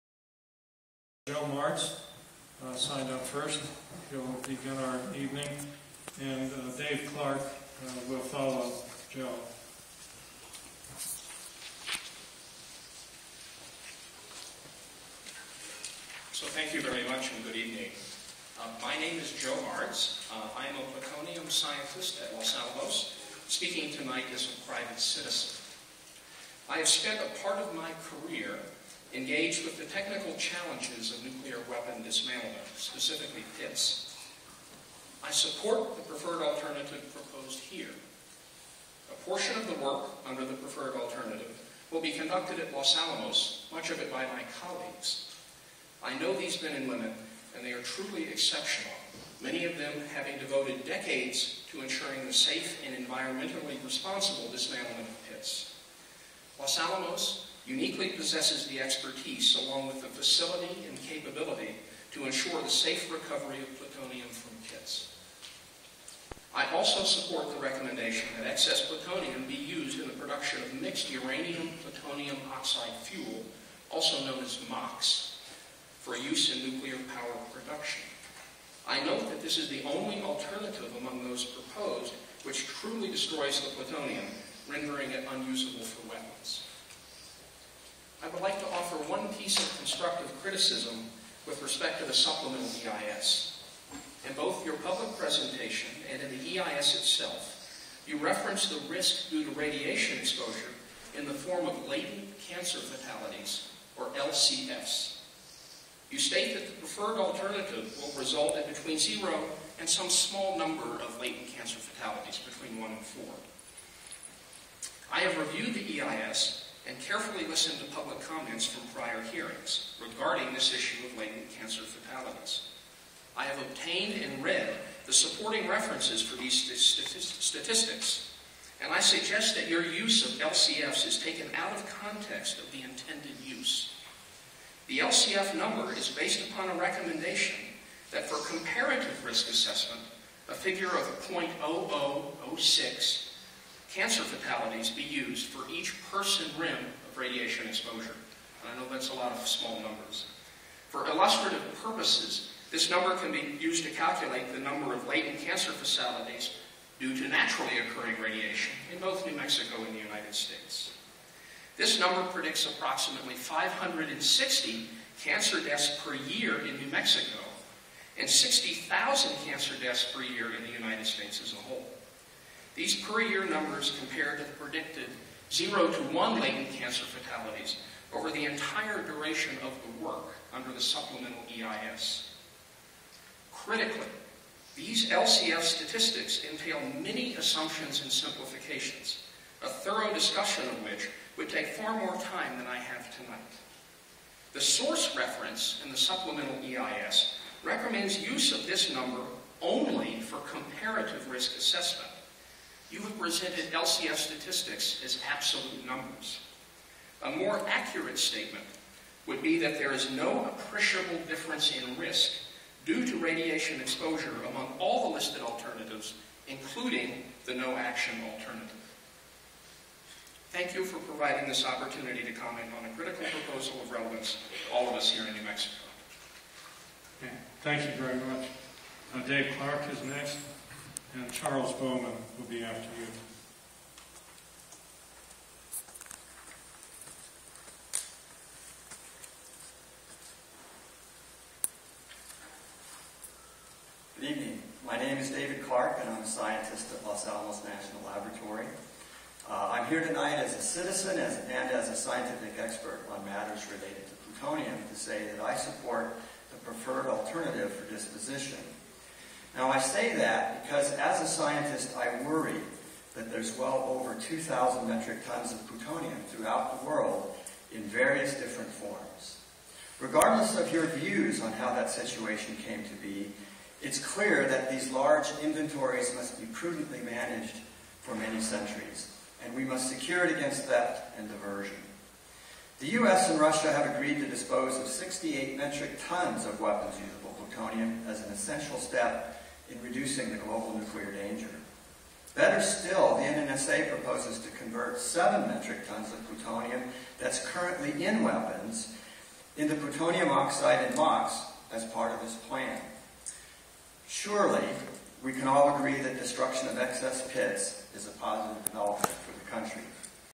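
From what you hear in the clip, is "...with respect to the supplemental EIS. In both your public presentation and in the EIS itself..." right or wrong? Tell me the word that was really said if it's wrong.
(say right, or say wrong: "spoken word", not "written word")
right.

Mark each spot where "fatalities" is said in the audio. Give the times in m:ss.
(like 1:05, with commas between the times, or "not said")
1:42, 1:51, 2:01, 2:24, 2:35, 2:57.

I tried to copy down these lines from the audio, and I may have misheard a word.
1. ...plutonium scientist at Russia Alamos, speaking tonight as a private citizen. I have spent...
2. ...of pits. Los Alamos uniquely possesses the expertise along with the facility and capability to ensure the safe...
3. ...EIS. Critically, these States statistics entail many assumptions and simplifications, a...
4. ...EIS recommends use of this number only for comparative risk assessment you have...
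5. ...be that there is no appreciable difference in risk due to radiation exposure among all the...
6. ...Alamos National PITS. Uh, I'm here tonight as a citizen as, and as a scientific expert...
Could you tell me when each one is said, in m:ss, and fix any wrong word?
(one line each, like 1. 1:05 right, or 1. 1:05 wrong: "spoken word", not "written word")
1. 0:21 wrong: "Los", not "Russia"
2. 0:55 right
3. 3:01 wrong: "LCF", not "States"
4. 3:16 right
5. 3:29 right
6. 4:07 wrong: "Laboratory", not "PITS".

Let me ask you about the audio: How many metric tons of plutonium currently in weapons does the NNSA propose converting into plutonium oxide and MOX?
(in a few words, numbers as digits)
7 metric tons.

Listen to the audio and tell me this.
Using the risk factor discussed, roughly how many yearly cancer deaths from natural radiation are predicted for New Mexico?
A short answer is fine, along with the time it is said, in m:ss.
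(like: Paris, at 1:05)
560, at 2:43.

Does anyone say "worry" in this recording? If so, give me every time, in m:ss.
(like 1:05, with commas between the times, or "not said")
4:22.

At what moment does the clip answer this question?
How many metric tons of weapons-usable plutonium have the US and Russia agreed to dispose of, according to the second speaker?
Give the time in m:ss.
4:44.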